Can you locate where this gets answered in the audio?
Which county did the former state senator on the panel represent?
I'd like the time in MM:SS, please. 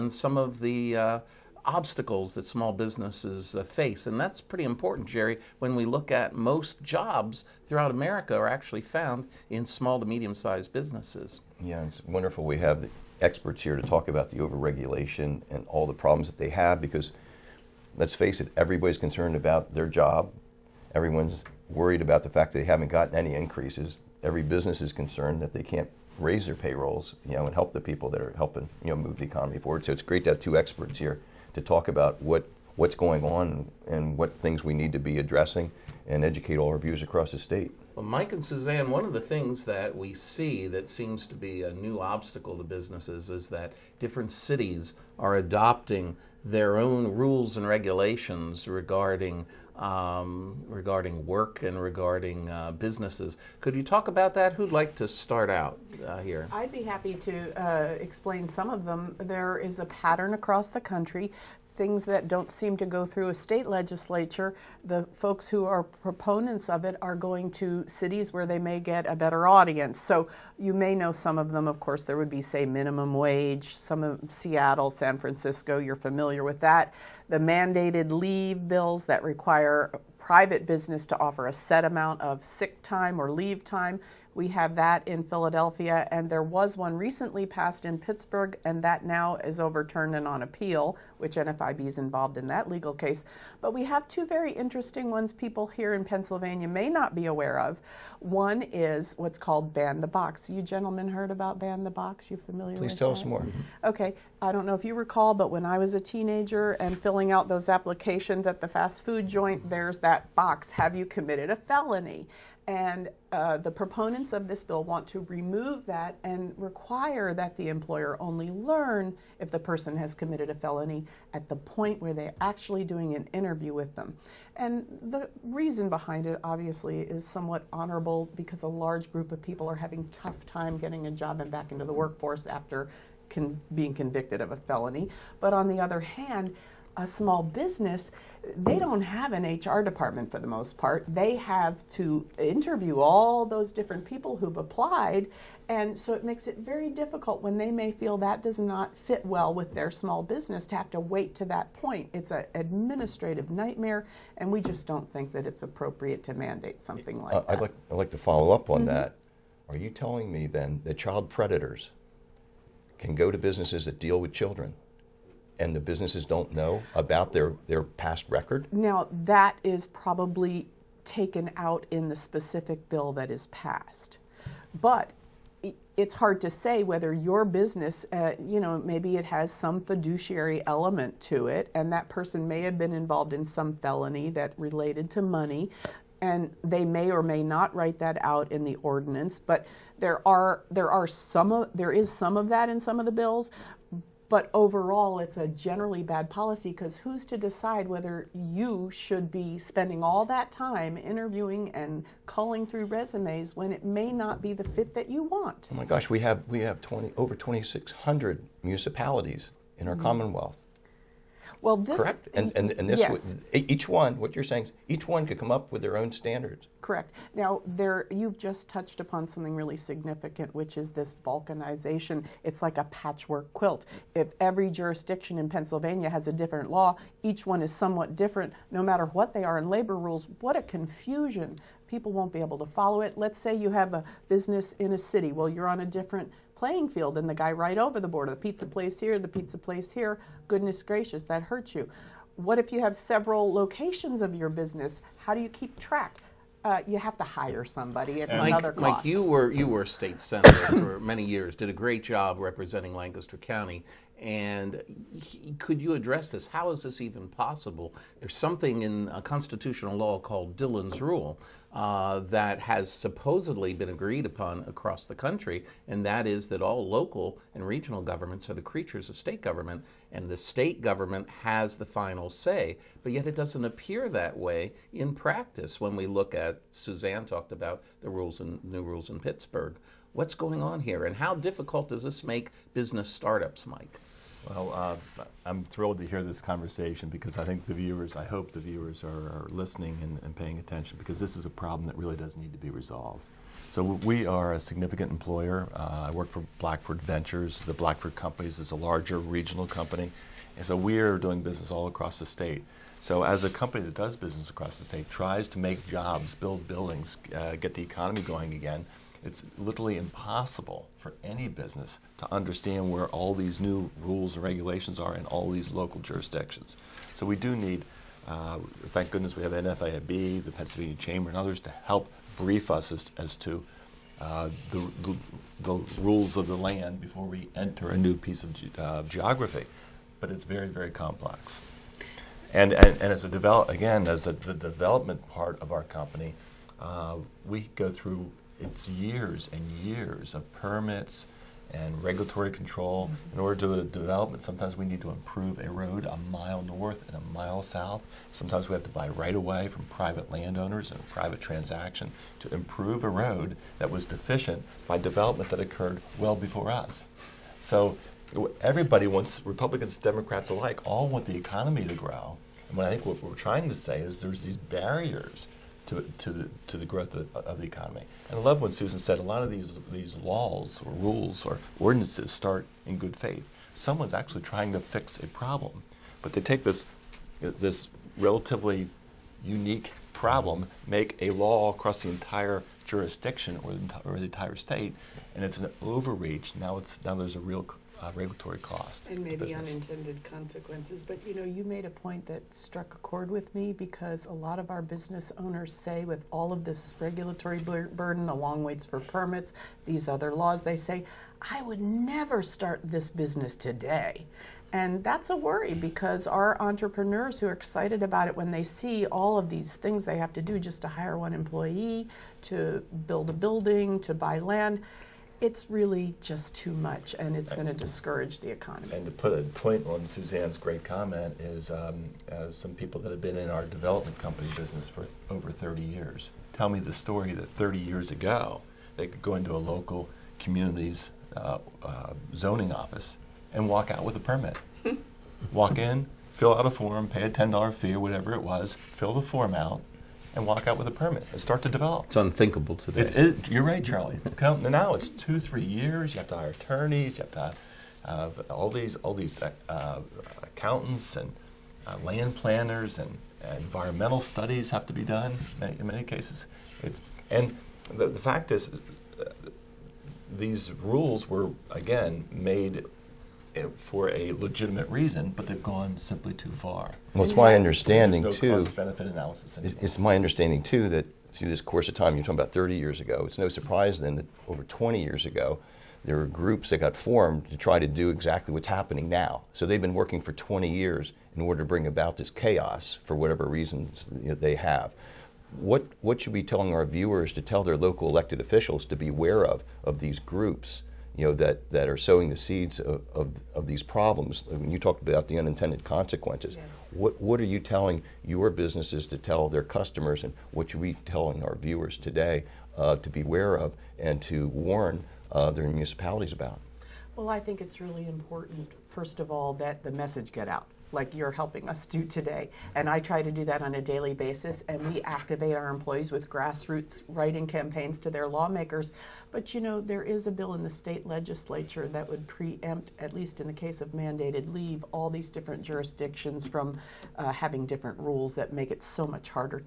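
04:12.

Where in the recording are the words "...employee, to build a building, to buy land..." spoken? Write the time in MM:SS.
06:51.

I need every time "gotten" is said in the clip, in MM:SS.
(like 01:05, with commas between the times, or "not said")
00:22.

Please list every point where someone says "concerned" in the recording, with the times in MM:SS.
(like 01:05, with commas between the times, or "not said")
00:18, 00:24.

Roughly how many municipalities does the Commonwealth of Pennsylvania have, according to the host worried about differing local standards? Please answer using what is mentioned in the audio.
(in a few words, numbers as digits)
2,600.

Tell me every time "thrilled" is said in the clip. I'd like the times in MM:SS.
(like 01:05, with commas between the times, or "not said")
04:45.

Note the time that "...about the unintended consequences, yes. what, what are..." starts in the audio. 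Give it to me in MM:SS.
08:15.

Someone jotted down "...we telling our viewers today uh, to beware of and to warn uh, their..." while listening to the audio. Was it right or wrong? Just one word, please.
right.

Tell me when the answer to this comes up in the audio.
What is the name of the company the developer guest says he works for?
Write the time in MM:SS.
04:56.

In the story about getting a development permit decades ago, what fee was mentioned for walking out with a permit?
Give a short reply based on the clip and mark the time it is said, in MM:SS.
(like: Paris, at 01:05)
$10, at 07:17.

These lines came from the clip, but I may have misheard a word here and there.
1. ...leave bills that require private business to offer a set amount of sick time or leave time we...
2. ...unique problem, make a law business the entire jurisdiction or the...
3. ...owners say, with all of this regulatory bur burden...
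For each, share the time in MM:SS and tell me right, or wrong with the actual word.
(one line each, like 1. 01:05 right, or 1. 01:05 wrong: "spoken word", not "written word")
1. 01:18 right
2. 06:19 wrong: "across", not "business"
3. 06:35 right.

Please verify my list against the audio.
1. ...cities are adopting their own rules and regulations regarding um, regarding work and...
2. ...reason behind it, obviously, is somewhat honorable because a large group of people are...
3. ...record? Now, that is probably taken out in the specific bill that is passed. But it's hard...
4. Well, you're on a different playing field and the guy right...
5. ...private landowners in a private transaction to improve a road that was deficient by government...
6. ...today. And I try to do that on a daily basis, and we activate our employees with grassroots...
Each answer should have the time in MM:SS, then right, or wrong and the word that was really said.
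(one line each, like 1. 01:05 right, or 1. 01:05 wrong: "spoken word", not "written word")
1. 00:44 right
2. 02:05 right
3. 02:48 right
4. 03:55 right
5. 05:49 wrong: "development", not "government"
6. 08:32 right.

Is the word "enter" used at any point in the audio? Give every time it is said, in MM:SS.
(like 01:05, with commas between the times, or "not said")
05:27.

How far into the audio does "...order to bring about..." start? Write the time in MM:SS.
08:01.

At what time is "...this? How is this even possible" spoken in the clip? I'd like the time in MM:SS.
04:16.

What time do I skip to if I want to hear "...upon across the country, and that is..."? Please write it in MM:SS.
04:24.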